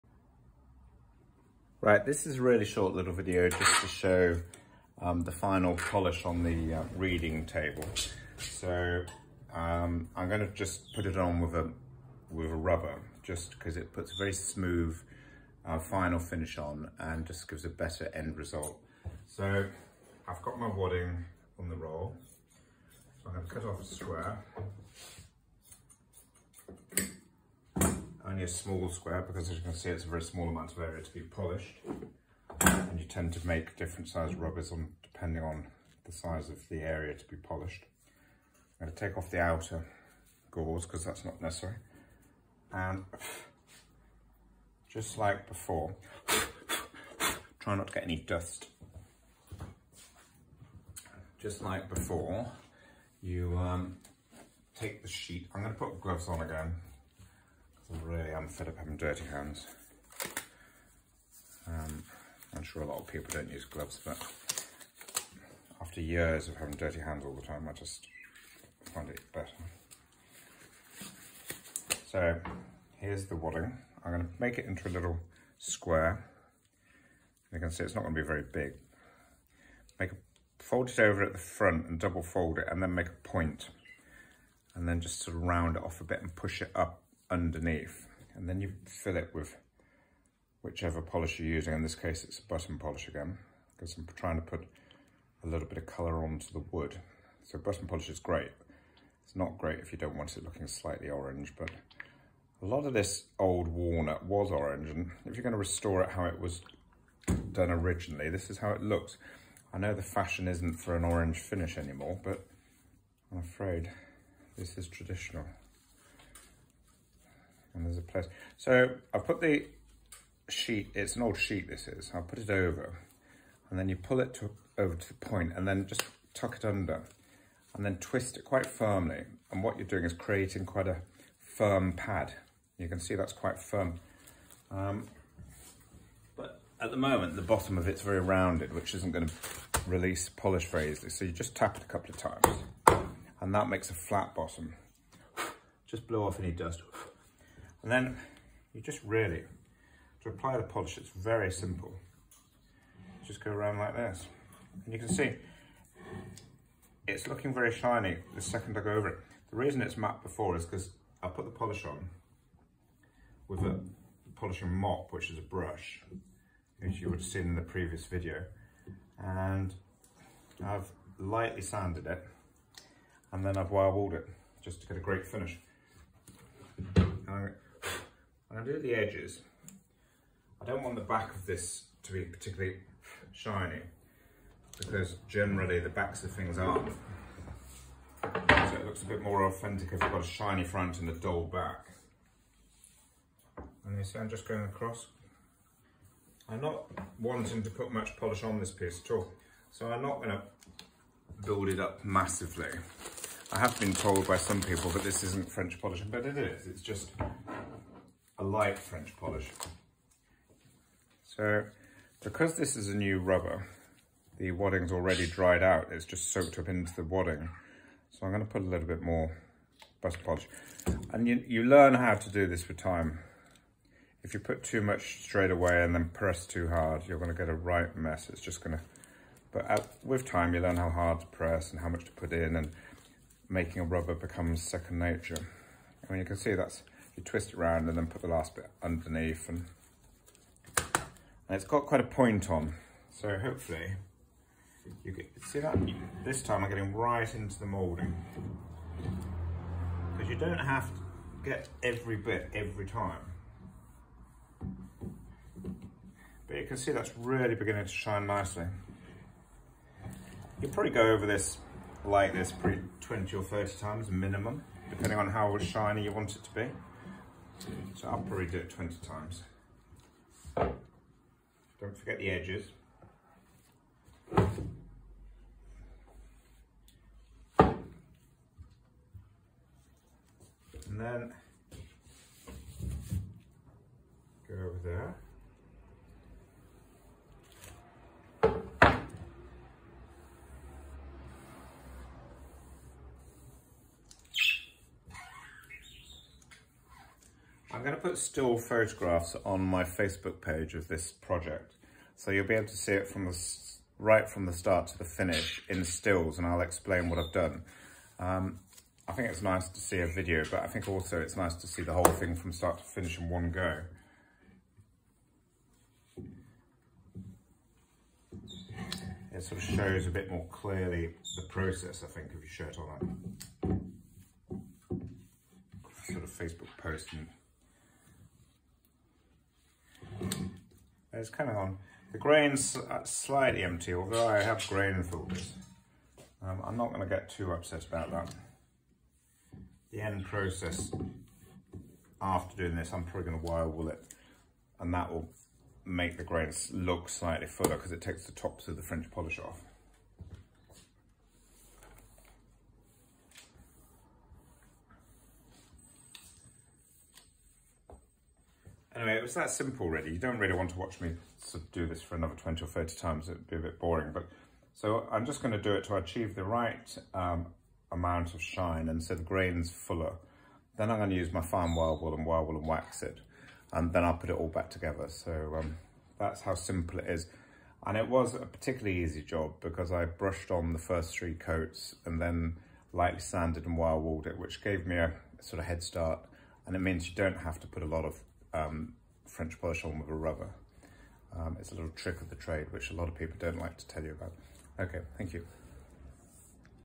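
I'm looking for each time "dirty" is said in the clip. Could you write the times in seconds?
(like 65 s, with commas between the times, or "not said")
58 s, 66 s.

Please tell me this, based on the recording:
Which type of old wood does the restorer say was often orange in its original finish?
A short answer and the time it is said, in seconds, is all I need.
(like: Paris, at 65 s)
walnut, at 103 s.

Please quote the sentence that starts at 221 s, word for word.
And you, you learn how to do this with time.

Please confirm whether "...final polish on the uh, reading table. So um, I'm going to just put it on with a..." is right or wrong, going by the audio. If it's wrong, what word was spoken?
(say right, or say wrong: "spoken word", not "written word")
right.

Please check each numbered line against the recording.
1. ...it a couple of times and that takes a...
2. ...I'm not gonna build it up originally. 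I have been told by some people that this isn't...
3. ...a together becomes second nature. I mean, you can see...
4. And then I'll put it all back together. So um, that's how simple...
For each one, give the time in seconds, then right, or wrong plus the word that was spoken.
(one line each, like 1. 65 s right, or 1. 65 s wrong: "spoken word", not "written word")
1. 141 s wrong: "makes", not "takes"
2. 199 s wrong: "massively", not "originally"
3. 233 s wrong: "rubber", not "together"
4. 373 s right.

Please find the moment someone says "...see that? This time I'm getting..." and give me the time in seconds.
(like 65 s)
245 s.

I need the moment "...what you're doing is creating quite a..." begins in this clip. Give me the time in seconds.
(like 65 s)
129 s.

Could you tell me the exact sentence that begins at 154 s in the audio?
And you can see, it's looking very shiny the second I go over it.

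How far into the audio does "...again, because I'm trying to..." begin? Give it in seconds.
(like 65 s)
93 s.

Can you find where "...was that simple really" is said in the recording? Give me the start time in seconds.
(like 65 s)
359 s.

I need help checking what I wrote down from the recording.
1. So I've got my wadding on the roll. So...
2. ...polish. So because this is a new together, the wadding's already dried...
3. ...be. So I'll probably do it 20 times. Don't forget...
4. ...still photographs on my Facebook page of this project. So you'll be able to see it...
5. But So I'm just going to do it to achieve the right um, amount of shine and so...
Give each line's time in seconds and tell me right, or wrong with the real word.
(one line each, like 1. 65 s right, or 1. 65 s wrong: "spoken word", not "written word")
1. 19 s right
2. 209 s wrong: "rubber", not "together"
3. 266 s right
4. 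298 s right
5. 364 s right.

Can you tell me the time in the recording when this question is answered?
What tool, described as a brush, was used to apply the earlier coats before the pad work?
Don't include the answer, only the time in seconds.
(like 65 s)
164 s.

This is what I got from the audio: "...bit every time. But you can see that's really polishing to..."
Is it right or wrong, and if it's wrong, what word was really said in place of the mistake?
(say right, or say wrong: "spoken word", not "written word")
wrong: "beginning", not "polishing".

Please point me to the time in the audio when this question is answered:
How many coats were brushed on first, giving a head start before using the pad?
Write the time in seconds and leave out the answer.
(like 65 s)
380 s.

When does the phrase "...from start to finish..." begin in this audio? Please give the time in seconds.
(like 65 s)
312 s.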